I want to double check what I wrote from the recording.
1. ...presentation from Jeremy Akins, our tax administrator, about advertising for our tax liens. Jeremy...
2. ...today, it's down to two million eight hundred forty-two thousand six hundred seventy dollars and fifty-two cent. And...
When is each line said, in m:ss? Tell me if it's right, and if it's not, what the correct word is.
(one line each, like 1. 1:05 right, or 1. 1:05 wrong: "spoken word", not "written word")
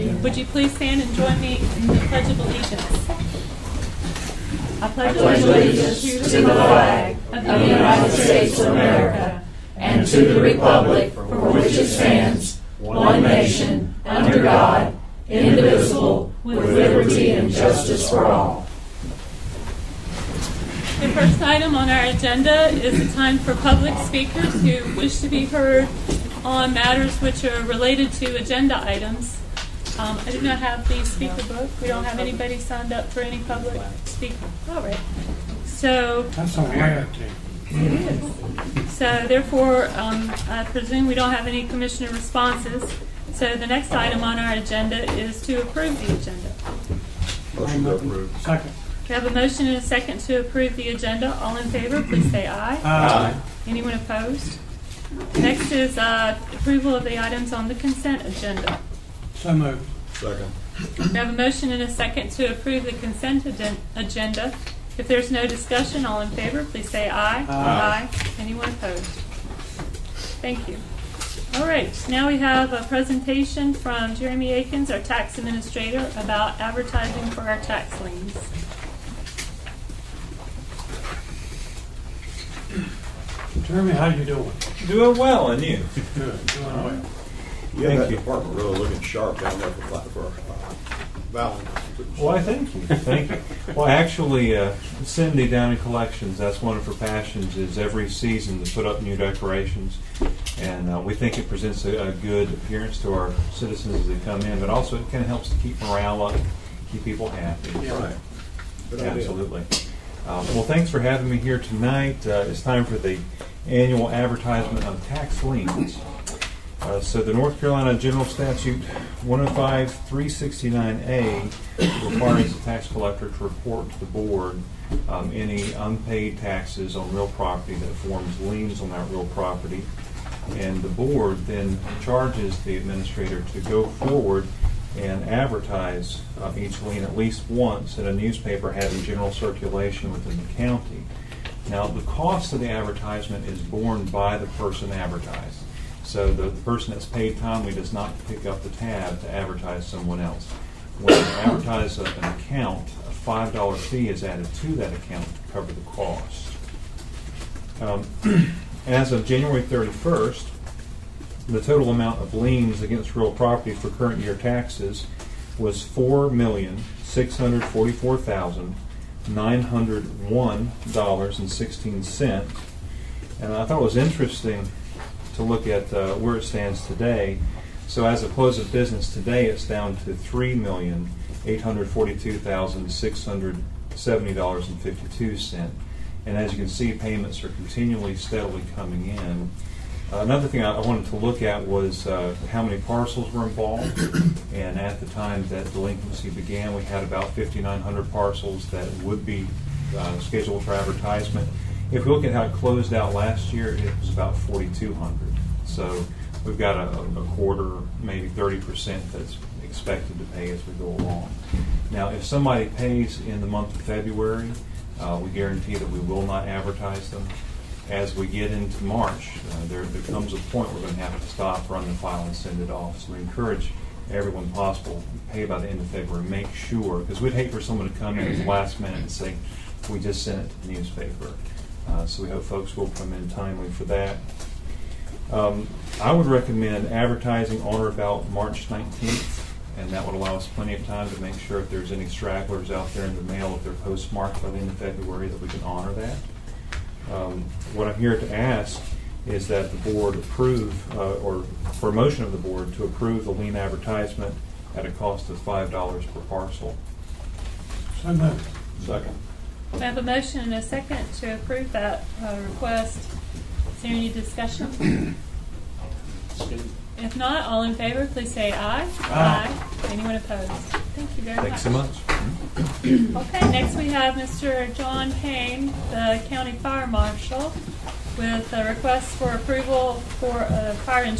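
1. 1:12 right
2. 2:59 wrong: "three", not "two".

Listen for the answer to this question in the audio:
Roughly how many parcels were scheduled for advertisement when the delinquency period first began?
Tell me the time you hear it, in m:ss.
3:17.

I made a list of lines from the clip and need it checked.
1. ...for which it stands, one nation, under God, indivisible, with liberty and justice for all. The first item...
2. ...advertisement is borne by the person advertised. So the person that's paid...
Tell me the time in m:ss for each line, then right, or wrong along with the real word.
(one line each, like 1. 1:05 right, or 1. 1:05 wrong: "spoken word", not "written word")
1. 0:11 right
2. 2:22 right.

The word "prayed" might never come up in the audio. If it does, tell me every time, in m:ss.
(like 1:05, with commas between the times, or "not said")
not said.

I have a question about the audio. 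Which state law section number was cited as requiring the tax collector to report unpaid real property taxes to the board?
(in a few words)
105-369A.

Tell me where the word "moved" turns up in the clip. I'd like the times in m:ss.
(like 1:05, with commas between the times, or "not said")
0:59, 4:18.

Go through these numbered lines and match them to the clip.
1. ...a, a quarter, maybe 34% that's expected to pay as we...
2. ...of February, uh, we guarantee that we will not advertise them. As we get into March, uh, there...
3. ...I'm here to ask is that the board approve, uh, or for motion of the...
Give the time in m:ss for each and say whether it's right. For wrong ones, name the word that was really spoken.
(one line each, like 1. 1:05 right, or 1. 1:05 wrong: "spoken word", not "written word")
1. 3:26 wrong: "30", not "34"
2. 3:33 right
3. 4:07 right.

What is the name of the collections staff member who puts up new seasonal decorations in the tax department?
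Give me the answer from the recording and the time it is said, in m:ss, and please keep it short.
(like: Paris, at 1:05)
Cindy, at 1:35.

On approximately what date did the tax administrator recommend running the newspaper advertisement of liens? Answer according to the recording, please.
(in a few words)
March 19th.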